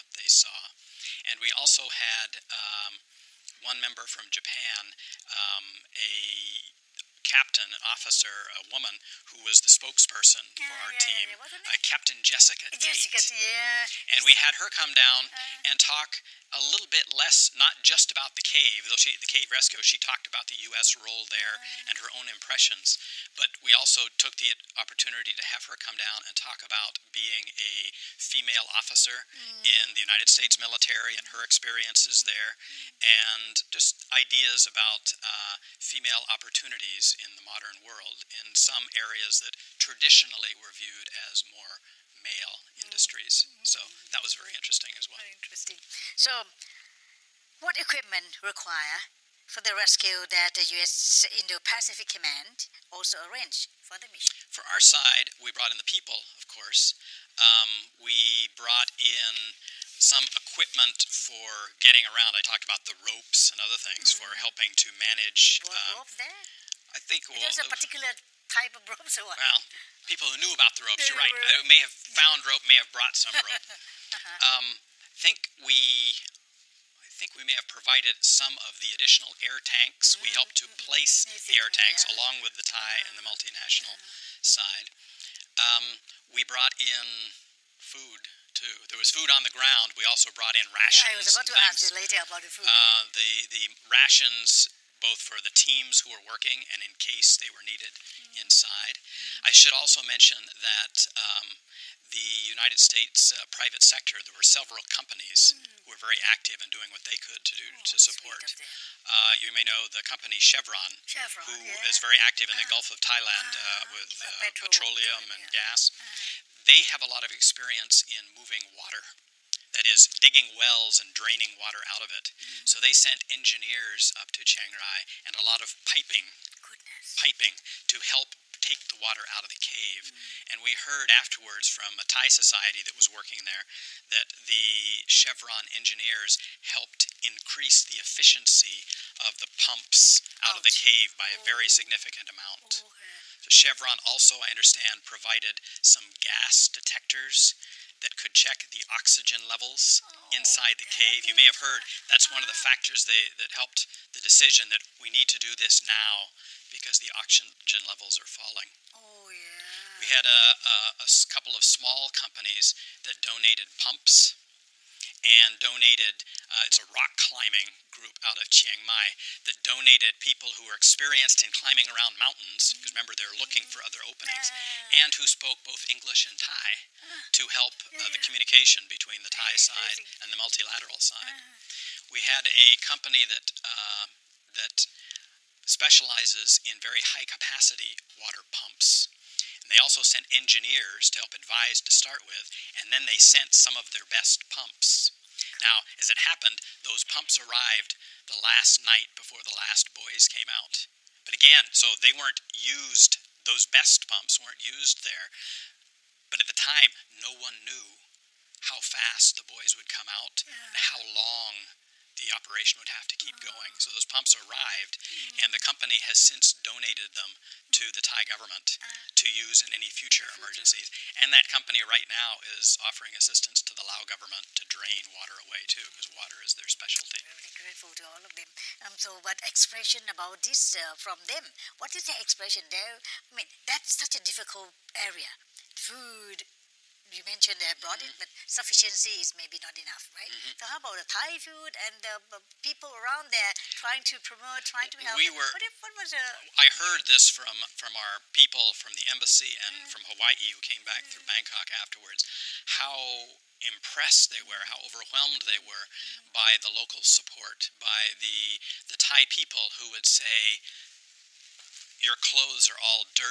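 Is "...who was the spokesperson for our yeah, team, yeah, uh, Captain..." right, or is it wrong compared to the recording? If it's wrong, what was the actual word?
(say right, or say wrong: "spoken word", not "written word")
right.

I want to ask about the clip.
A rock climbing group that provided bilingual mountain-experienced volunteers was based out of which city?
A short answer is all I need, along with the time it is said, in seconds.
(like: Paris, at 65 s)
Chiang Mai, at 168 s.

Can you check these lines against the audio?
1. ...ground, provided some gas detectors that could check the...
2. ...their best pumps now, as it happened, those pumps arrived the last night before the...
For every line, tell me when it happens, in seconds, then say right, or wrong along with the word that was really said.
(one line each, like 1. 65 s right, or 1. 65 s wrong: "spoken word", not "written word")
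1. 144 s wrong: "understand", not "ground"
2. 193 s right.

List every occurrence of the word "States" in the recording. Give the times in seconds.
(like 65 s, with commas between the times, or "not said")
30 s, 102 s.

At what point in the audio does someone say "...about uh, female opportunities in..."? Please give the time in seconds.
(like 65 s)
34 s.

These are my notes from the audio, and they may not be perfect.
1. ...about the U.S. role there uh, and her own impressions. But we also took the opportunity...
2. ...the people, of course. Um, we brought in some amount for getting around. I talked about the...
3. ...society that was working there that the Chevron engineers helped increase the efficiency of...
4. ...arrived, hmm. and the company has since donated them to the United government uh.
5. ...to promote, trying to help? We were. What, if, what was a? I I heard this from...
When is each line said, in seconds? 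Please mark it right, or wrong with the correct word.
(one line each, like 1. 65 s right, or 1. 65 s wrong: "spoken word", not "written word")
1. 20 s right
2. 55 s wrong: "equipment", not "amount"
3. 132 s right
4. 214 s wrong: "Thai", not "United"
5. 244 s right.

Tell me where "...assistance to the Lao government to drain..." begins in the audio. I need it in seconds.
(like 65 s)
223 s.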